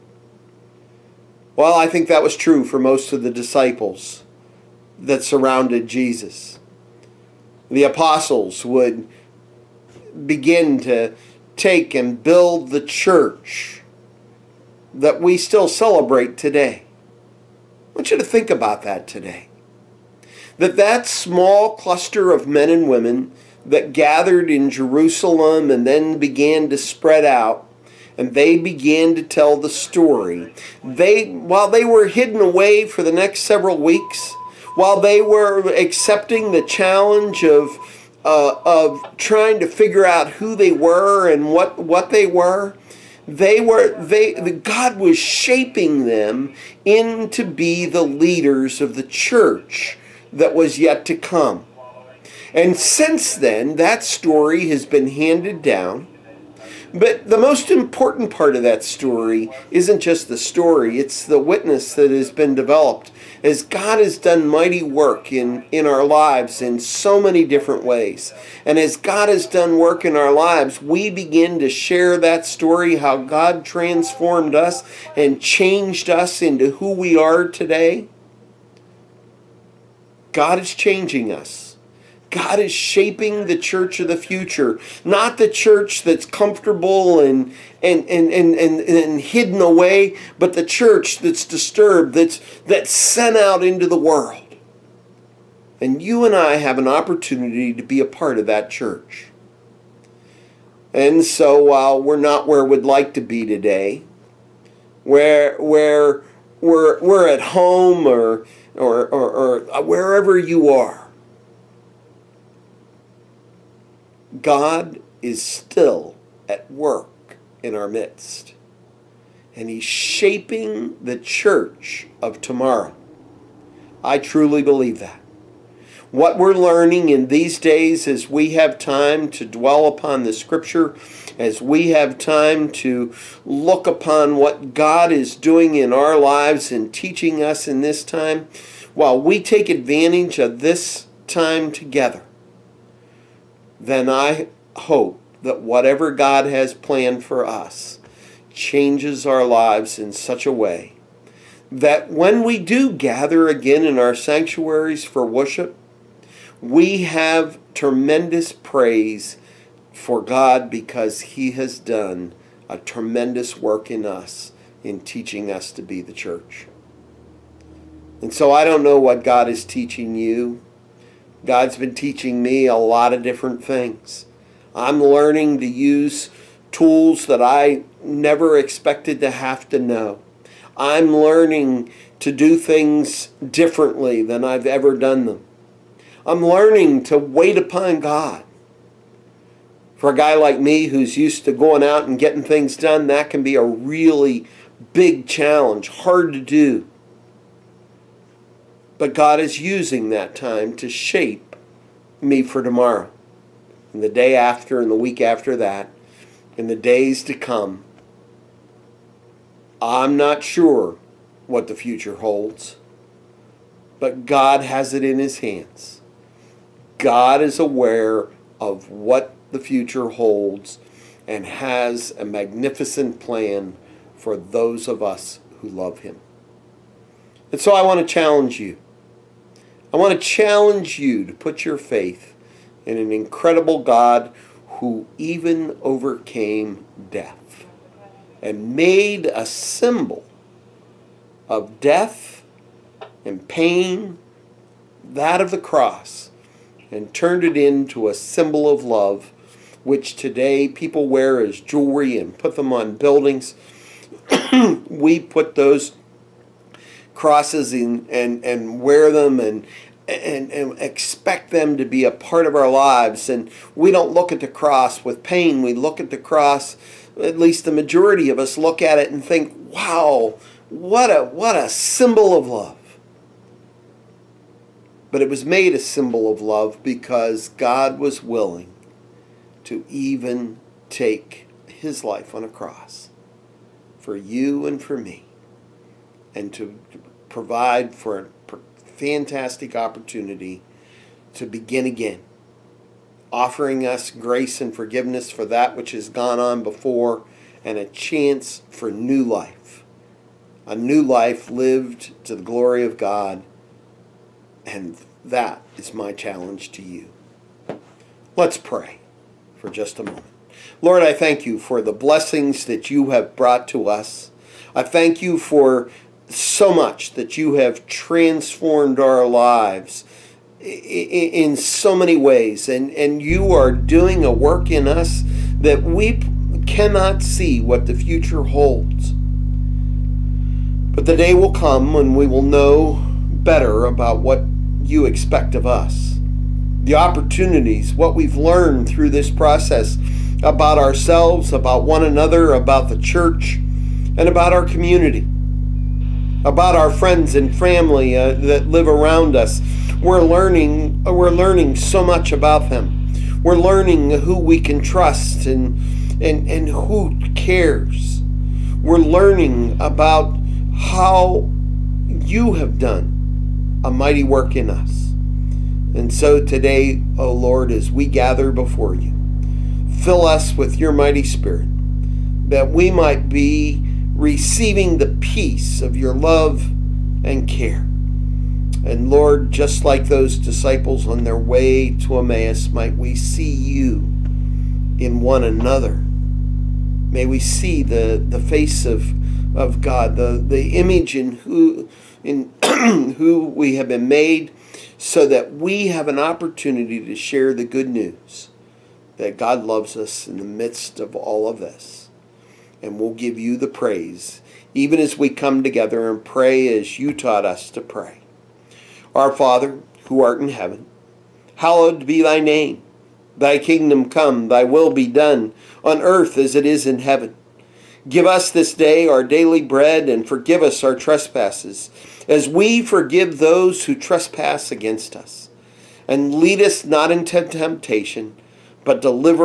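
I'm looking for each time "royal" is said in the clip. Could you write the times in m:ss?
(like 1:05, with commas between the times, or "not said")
not said.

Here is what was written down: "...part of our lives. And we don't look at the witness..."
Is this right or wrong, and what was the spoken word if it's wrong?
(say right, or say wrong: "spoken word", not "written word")
wrong: "cross", not "witness".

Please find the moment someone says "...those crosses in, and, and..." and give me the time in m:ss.
4:15.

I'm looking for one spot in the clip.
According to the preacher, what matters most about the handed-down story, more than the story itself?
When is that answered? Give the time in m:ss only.
1:01.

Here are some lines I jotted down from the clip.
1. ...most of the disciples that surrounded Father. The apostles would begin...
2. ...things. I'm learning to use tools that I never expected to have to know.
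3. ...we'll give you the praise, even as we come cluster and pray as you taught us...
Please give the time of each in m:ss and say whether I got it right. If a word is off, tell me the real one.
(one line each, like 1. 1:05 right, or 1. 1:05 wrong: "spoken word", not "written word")
1. 0:02 wrong: "Jesus", not "Father"
2. 2:53 right
3. 6:42 wrong: "together", not "cluster".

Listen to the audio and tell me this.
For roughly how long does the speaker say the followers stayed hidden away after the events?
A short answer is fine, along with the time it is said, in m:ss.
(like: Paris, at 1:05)
several weeks, at 0:33.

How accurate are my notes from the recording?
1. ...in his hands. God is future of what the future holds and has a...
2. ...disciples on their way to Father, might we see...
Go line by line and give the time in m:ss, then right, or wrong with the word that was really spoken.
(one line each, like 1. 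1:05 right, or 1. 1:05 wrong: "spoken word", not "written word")
1. 3:35 wrong: "aware", not "future"
2. 6:20 wrong: "Emmaus", not "Father".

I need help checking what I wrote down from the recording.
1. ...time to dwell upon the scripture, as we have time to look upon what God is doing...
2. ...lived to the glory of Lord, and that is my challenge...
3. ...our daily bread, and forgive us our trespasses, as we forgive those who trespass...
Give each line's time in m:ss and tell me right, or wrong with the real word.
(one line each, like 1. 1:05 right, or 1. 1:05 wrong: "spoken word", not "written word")
1. 2:08 right
2. 5:01 wrong: "God", not "Lord"
3. 6:59 right.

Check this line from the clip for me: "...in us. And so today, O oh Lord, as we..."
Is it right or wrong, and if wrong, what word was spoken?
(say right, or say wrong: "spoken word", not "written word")
right.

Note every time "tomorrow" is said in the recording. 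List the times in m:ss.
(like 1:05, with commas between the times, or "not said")
2:02, 3:22.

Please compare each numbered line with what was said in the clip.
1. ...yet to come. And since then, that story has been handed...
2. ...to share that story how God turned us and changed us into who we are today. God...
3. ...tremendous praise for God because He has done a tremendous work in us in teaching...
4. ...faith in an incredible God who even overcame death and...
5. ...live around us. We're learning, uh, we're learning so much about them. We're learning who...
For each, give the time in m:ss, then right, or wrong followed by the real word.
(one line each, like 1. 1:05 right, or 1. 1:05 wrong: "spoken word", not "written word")
1. 0:50 right
2. 1:11 wrong: "transformed", not "turned"
3. 2:37 right
4. 3:51 right
5. 5:48 right.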